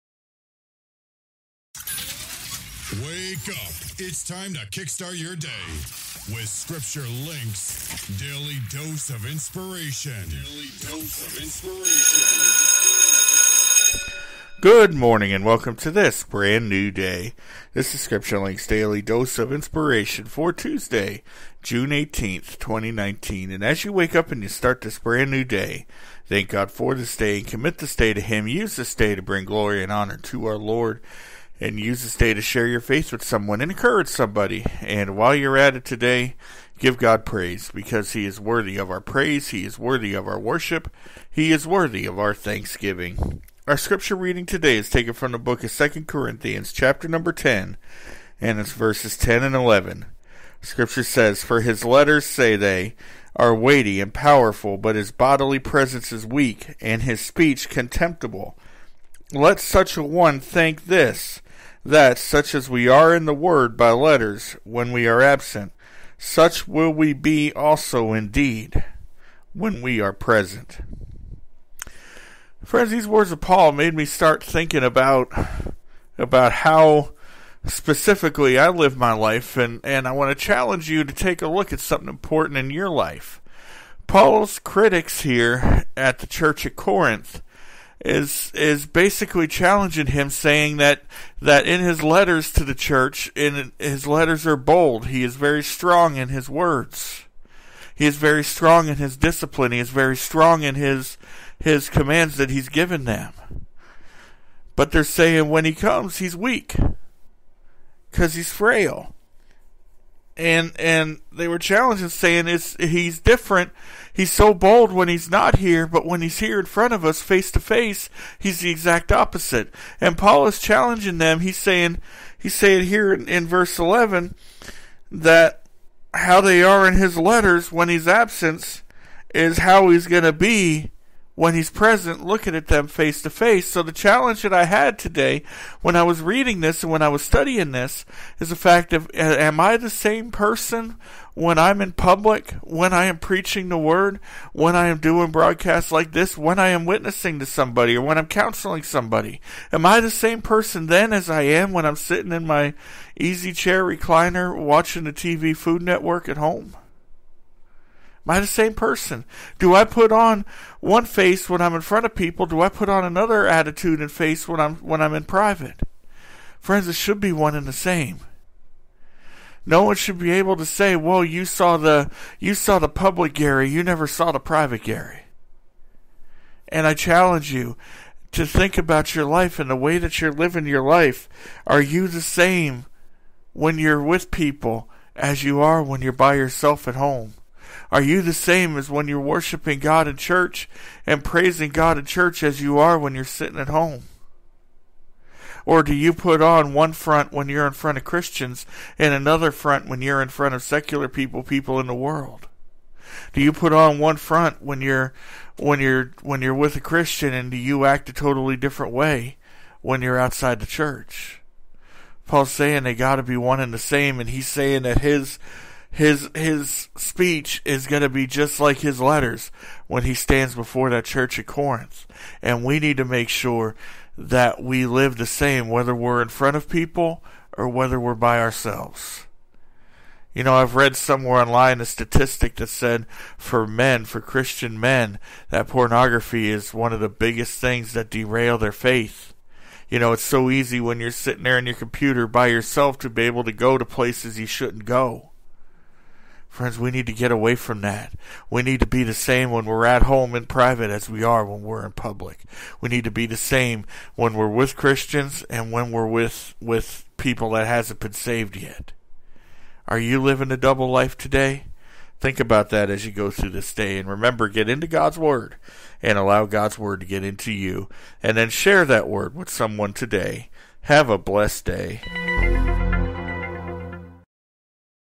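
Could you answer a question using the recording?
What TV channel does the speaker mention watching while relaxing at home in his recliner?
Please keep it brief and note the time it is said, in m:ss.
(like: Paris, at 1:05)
Food Network, at 2:35.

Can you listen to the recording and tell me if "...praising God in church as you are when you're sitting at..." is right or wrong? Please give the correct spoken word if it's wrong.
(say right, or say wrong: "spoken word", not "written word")
right.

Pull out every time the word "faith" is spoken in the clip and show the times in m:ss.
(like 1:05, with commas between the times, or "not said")
0:32, 3:58.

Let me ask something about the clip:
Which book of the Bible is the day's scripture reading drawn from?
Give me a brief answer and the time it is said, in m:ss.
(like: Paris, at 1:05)
2 Corinthians, at 0:45.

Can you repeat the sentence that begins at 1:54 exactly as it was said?
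He's so bold when he's not here, but when he's here in front of us, face to face, he's the exact opposite.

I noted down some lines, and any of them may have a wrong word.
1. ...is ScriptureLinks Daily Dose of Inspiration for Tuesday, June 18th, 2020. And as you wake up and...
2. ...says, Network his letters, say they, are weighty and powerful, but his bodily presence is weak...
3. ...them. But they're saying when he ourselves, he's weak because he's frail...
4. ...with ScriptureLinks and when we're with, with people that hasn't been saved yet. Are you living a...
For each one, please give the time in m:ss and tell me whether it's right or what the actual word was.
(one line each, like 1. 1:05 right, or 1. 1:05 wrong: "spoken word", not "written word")
1. 0:17 wrong: "2019", not "2020"
2. 0:51 wrong: "For", not "Network"
3. 1:43 wrong: "comes", not "ourselves"
4. 4:14 wrong: "Christians", not "ScriptureLinks".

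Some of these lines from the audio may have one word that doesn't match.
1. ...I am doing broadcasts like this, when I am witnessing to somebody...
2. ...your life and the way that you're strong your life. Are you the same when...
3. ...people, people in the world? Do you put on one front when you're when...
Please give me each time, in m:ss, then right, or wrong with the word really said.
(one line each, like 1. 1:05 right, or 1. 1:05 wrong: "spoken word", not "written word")
1. 2:24 right
2. 2:59 wrong: "living", not "strong"
3. 3:21 right.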